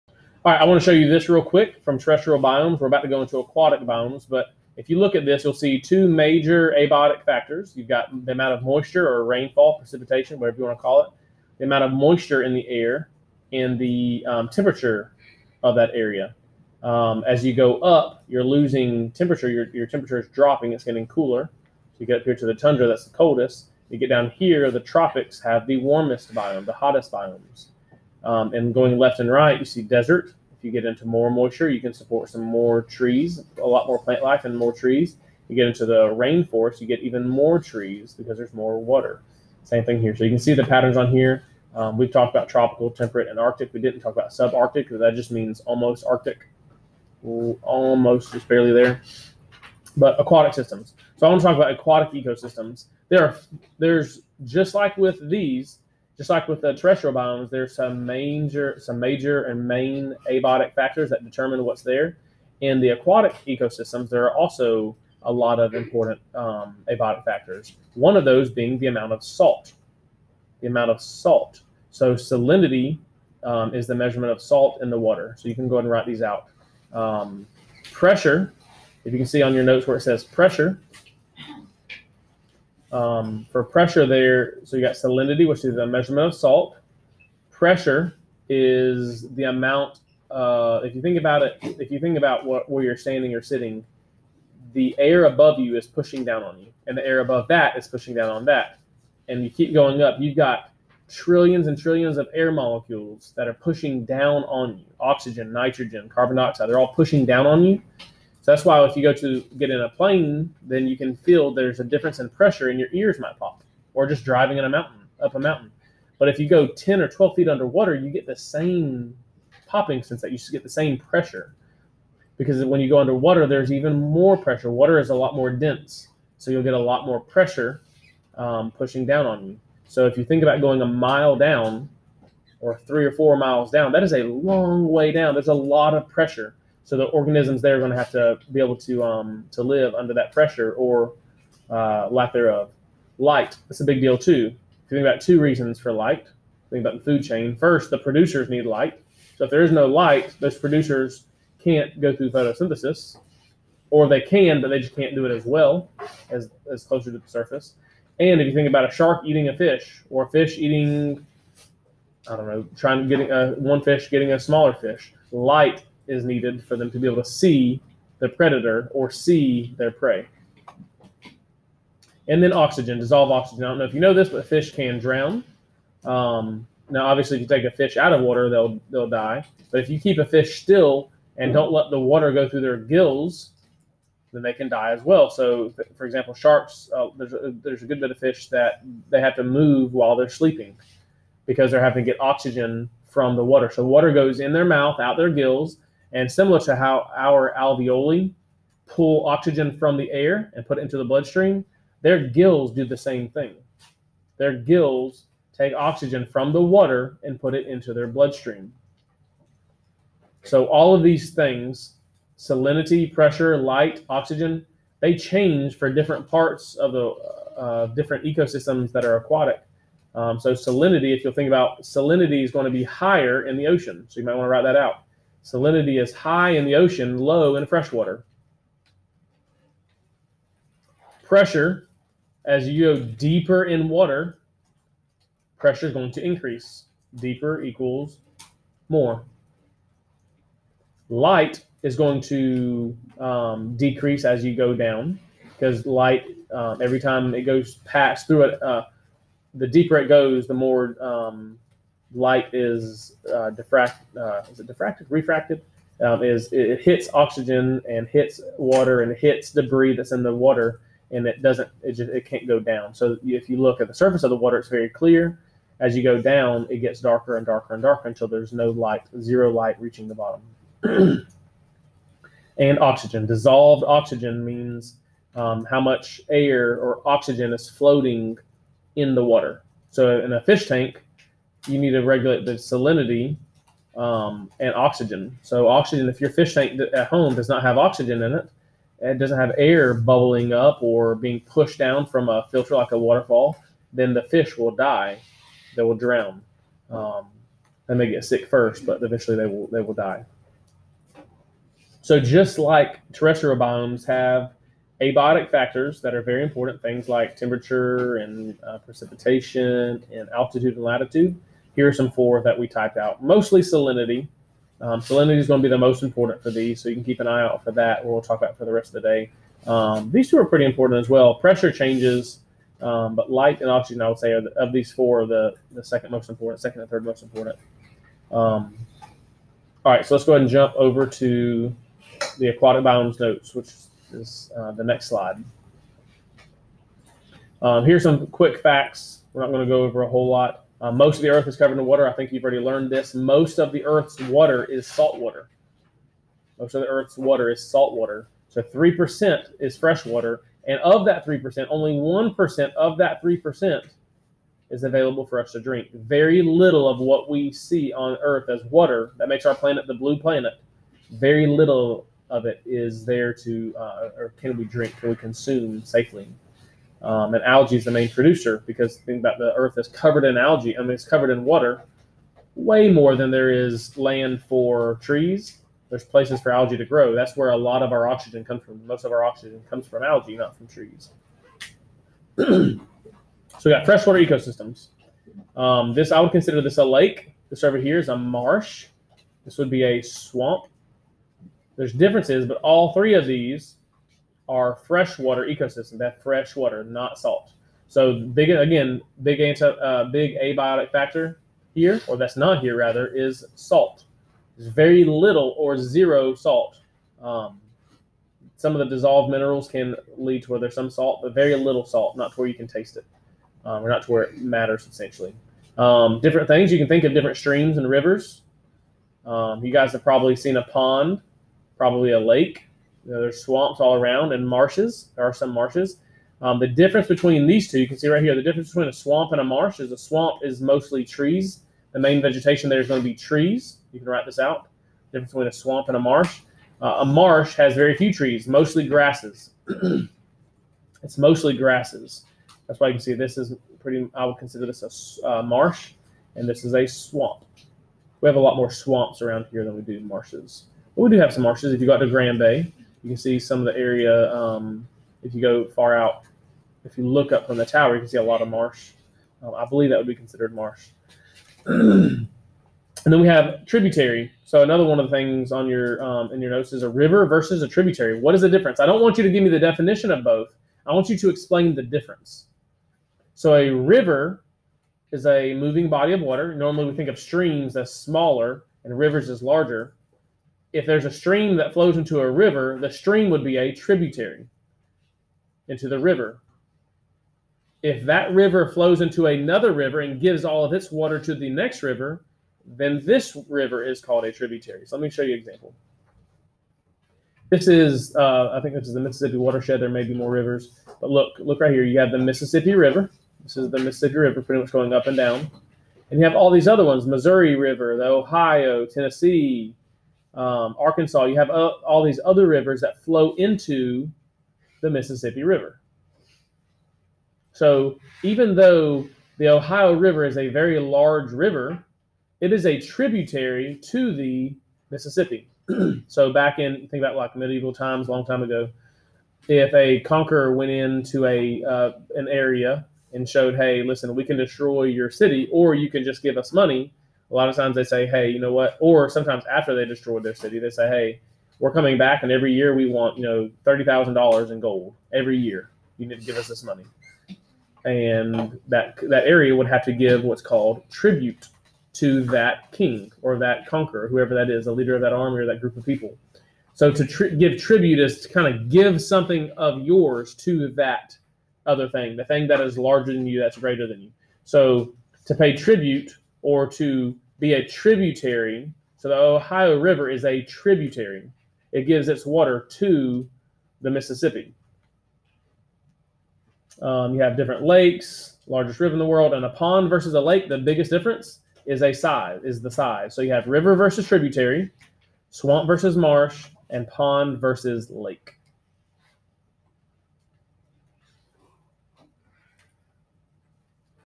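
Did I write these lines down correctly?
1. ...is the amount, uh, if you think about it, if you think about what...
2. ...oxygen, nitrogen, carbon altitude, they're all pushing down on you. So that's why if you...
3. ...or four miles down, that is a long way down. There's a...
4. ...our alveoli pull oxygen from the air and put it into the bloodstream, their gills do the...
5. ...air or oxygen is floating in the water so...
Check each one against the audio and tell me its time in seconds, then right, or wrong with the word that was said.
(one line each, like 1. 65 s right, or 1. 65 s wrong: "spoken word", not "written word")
1. 88 s right
2. 104 s wrong: "dioxide", not "altitude"
3. 133 s right
4. 197 s right
5. 276 s right.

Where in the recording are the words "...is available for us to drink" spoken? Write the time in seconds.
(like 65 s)
354 s.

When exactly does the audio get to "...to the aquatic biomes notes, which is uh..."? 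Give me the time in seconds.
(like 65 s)
331 s.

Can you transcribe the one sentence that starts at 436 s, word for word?
Uh, a marsh has very few trees, mostly grasses.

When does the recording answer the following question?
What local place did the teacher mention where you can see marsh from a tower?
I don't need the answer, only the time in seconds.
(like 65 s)
452 s.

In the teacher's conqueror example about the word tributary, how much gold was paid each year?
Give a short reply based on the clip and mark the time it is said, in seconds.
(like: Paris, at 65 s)
$30,000, at 543 s.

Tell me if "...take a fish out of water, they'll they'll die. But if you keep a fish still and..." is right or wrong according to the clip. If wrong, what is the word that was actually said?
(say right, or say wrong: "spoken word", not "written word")
right.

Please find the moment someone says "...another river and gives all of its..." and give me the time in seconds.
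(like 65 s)
489 s.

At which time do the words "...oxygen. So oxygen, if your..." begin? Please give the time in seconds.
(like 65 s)
284 s.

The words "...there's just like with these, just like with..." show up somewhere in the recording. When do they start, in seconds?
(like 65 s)
53 s.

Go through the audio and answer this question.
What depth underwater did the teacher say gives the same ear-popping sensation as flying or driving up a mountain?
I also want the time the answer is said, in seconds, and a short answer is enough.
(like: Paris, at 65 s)
10 or 12 feet, at 116 s.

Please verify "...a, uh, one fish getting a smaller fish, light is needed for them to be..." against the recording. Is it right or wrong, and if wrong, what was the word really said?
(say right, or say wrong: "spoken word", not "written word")
right.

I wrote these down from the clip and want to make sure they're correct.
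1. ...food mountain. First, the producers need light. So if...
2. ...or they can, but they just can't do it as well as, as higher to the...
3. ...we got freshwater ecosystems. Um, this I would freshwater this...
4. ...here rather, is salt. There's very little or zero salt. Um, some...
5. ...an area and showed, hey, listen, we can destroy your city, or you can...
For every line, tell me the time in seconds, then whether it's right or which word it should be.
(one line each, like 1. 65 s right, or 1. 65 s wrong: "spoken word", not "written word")
1. 147 s wrong: "chain", not "mountain"
2. 153 s wrong: "closer", not "higher"
3. 383 s wrong: "consider", not "freshwater"
4. 402 s right
5. 532 s right.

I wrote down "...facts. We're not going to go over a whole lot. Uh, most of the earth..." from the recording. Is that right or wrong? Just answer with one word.
right.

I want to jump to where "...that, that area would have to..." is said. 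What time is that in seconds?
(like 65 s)
548 s.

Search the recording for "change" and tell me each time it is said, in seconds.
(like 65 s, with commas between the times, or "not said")
215 s, 321 s.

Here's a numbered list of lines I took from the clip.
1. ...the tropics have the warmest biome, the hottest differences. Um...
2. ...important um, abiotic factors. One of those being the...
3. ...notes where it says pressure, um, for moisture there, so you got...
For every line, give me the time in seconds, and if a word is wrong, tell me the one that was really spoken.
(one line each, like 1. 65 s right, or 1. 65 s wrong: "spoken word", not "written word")
1. 24 s wrong: "biomes", not "differences"
2. 65 s right
3. 79 s wrong: "pressure", not "moisture".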